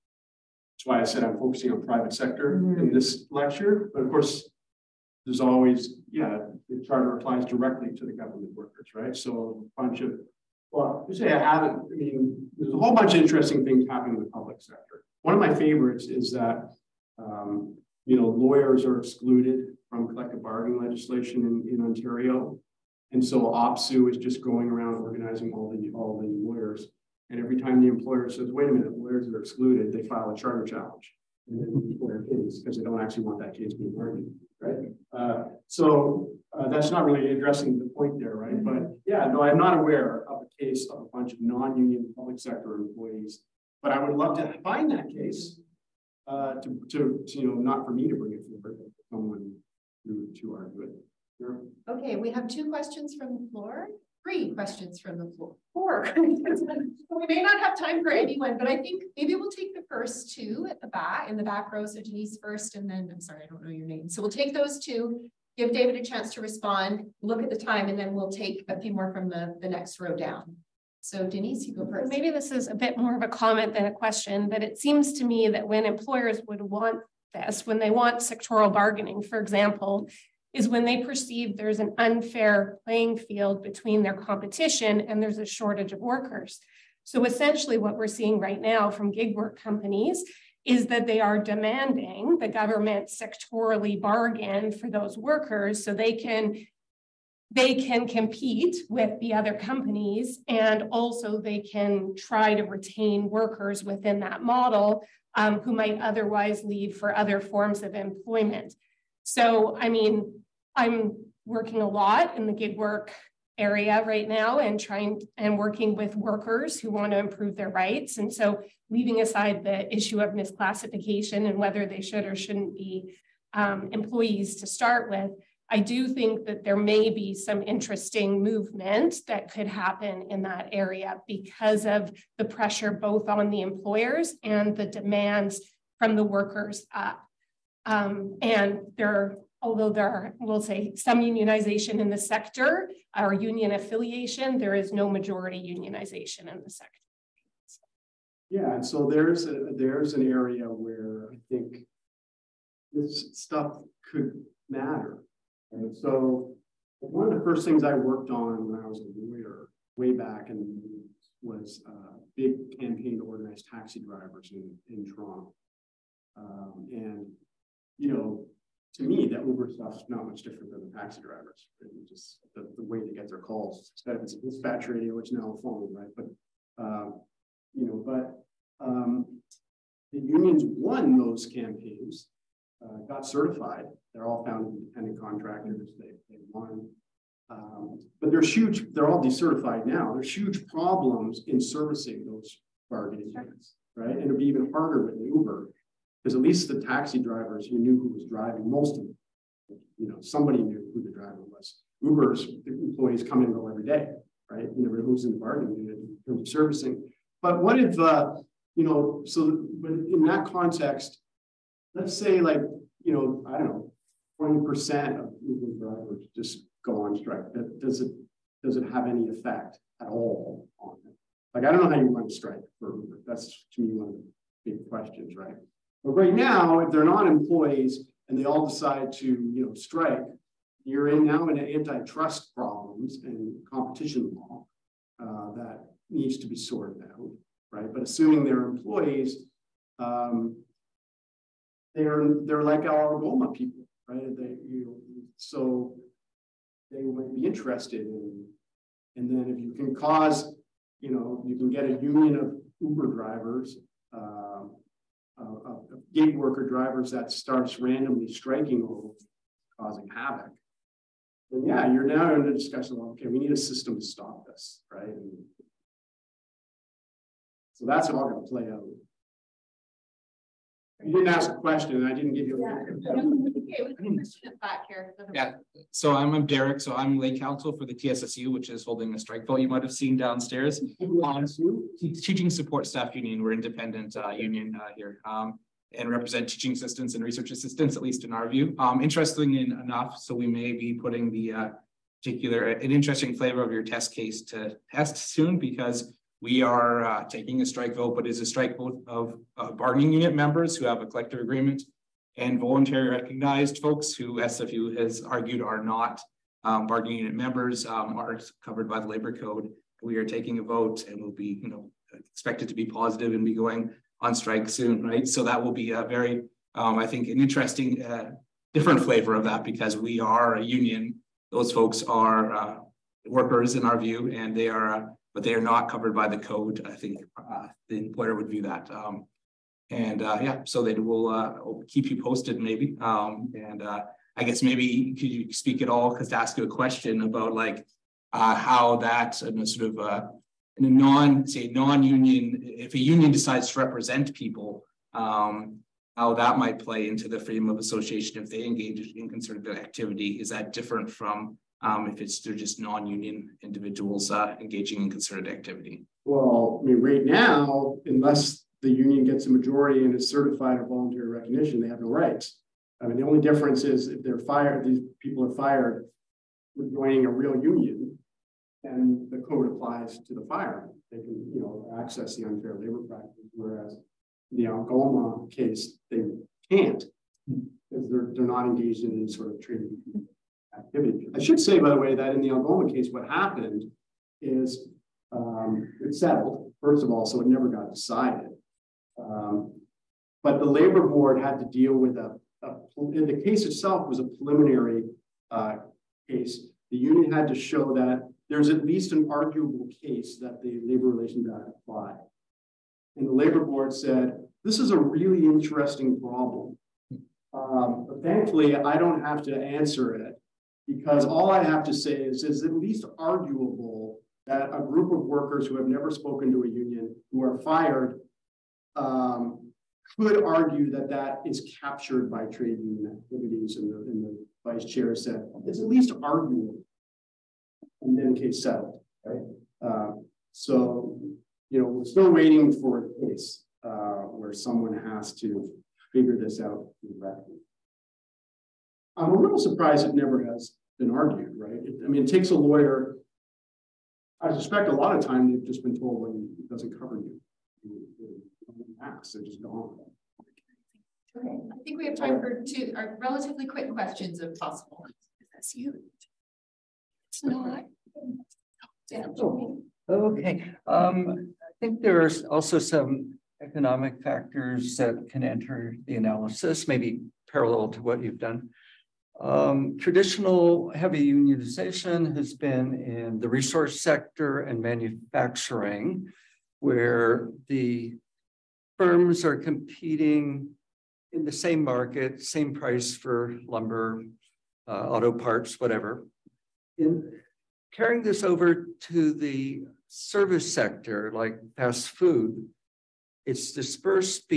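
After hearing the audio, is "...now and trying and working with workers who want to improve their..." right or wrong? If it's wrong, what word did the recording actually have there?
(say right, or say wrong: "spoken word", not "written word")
right.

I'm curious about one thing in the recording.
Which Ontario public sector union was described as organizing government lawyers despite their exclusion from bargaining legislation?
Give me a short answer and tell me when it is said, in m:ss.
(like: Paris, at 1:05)
OPSEU, at 0:23.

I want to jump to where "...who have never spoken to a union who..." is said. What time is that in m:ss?
6:55.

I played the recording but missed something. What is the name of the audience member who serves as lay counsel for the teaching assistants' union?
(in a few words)
Derek.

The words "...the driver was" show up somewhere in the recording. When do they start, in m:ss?
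3:21.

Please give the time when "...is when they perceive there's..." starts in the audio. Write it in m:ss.
1:20.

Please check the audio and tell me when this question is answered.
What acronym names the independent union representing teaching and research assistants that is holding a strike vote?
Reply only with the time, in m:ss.
4:37.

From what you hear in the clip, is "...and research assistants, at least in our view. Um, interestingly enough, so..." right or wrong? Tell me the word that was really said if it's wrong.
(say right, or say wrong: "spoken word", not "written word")
right.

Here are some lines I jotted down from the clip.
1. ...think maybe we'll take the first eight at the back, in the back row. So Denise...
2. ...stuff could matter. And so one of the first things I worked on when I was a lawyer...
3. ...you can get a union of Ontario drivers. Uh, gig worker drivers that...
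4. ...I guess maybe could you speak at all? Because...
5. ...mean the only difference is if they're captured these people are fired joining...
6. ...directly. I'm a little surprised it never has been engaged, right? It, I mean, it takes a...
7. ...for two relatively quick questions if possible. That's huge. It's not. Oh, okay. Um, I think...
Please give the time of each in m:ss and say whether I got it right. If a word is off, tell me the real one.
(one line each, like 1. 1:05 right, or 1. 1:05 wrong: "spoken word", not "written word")
1. 0:58 wrong: "two", not "eight"
2. 2:33 right
3. 4:11 wrong: "Uber", not "Ontario"
4. 5:33 right
5. 6:03 wrong: "fired", not "captured"
6. 7:17 wrong: "argued", not "engaged"
7. 7:32 right.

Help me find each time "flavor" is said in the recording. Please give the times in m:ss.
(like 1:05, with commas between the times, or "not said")
4:53, 5:19.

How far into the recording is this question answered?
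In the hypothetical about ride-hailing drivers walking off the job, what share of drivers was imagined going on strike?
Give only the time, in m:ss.
3:34.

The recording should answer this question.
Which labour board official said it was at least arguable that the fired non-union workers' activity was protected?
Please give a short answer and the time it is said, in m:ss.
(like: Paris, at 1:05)
the vice chair, at 7:04.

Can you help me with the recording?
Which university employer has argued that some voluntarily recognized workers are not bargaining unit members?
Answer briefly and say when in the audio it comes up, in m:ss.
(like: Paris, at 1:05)
SFU, at 5:04.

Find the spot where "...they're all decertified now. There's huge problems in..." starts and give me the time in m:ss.
3:08.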